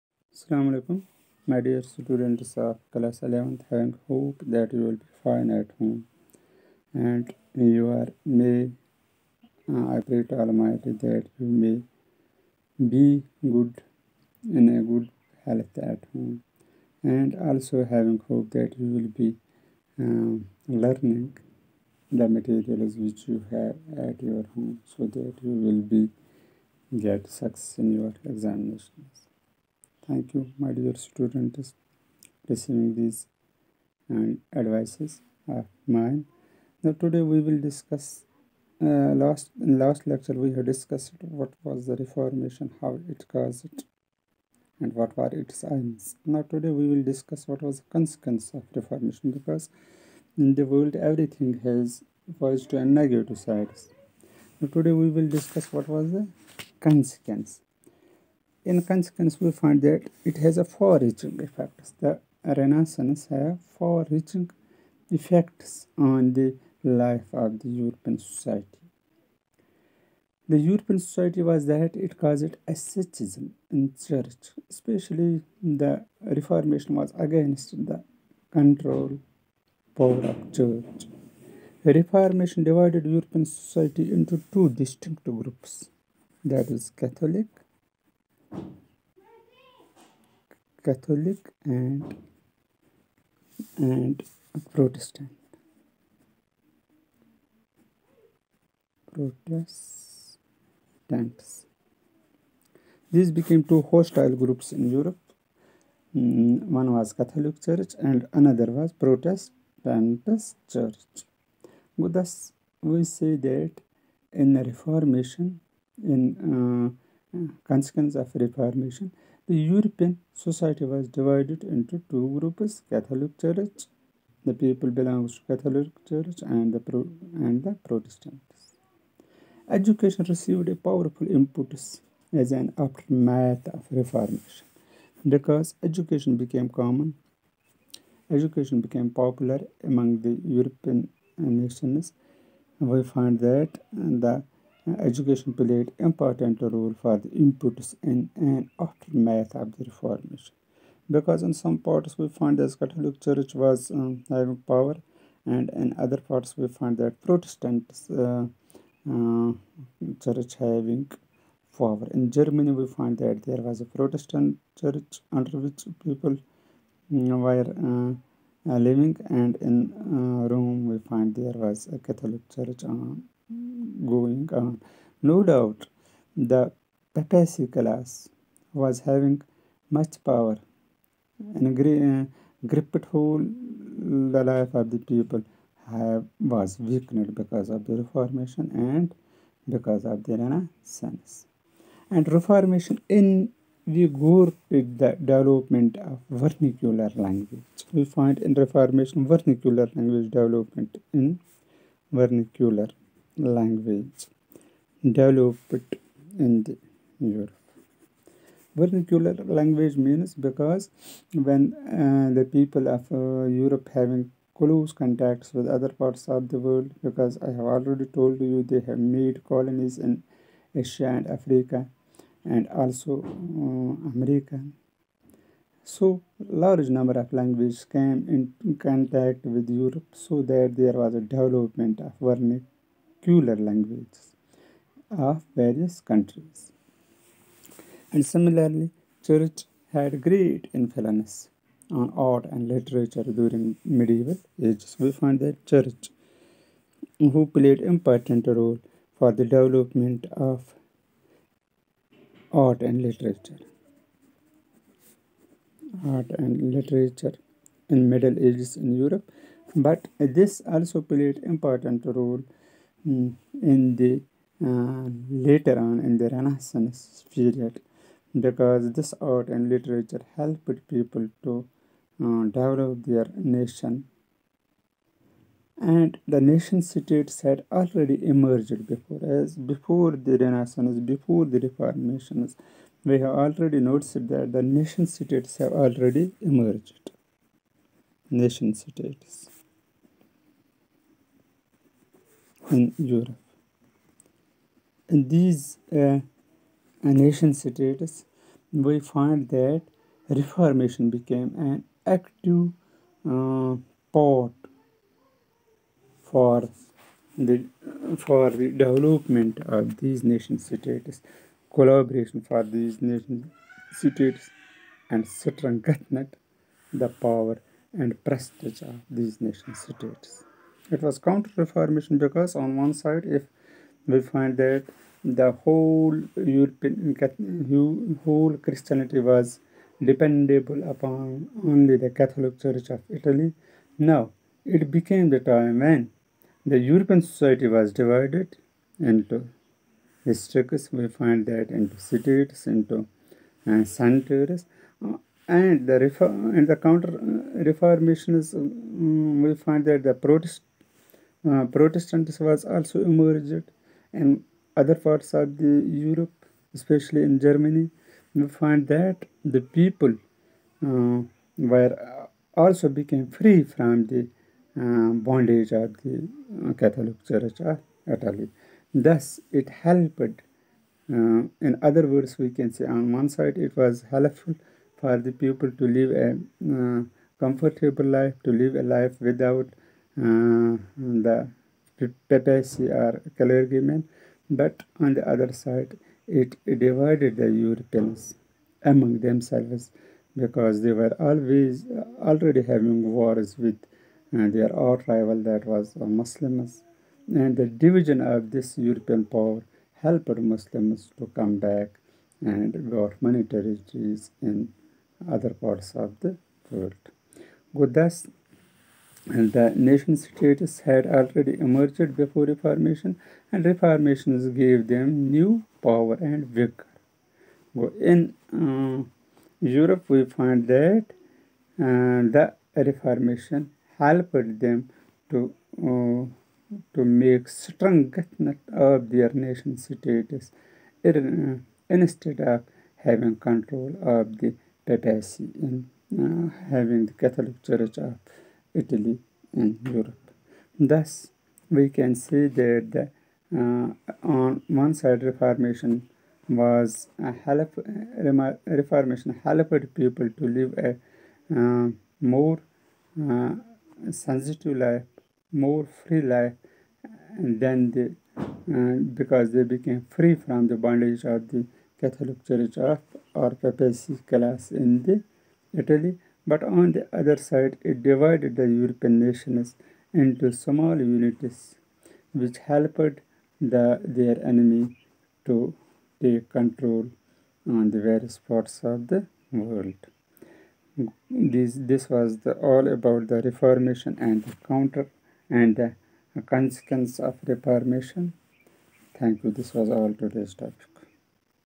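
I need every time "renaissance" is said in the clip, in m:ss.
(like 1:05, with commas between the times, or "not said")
1:02, 3:10, 4:26, 4:40.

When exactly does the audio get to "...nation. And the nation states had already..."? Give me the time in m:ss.
4:33.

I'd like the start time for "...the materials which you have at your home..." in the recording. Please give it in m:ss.
0:22.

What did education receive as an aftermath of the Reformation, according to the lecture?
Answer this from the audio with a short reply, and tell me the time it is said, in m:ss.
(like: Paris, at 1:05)
a powerful input, at 2:10.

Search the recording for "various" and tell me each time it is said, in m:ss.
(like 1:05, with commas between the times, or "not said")
3:55, 7:58.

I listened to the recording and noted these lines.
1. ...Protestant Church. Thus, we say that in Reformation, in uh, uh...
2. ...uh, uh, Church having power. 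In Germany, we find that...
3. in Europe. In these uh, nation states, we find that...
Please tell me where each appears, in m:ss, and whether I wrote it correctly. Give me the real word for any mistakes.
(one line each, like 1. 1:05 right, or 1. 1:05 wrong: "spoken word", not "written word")
1. 1:48 right
2. 2:38 right
3. 4:52 right.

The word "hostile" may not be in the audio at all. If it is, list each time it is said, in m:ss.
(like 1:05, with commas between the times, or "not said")
1:43.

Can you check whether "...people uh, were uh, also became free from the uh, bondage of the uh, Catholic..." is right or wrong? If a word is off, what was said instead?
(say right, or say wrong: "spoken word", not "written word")
right.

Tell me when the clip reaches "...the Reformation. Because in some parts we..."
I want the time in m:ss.
2:29.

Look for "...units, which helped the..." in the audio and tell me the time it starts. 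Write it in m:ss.
7:50.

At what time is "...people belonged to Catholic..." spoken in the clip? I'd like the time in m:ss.
2:04.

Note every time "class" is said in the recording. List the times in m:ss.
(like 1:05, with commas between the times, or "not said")
0:02, 2:57, 7:44.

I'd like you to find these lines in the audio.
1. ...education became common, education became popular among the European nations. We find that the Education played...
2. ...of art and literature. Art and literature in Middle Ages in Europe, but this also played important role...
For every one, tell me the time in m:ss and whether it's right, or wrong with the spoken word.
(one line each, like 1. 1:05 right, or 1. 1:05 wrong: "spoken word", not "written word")
1. 2:15 right
2. 4:10 right.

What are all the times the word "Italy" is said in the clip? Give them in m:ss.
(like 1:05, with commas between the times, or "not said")
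5:33, 6:08, 7:18, 7:45.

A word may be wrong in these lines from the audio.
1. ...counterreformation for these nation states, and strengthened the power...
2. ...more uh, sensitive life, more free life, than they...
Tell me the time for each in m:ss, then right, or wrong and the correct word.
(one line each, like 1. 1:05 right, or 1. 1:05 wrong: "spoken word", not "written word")
1. 5:11 wrong: "collaboration", not "counterreformation"
2. 7:32 right.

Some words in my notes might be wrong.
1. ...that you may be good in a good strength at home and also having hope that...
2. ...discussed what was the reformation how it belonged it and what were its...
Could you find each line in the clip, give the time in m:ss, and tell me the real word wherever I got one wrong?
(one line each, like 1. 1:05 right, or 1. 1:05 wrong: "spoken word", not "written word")
1. 0:11 wrong: "health", not "strength"
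2. 0:40 wrong: "caused", not "belonged".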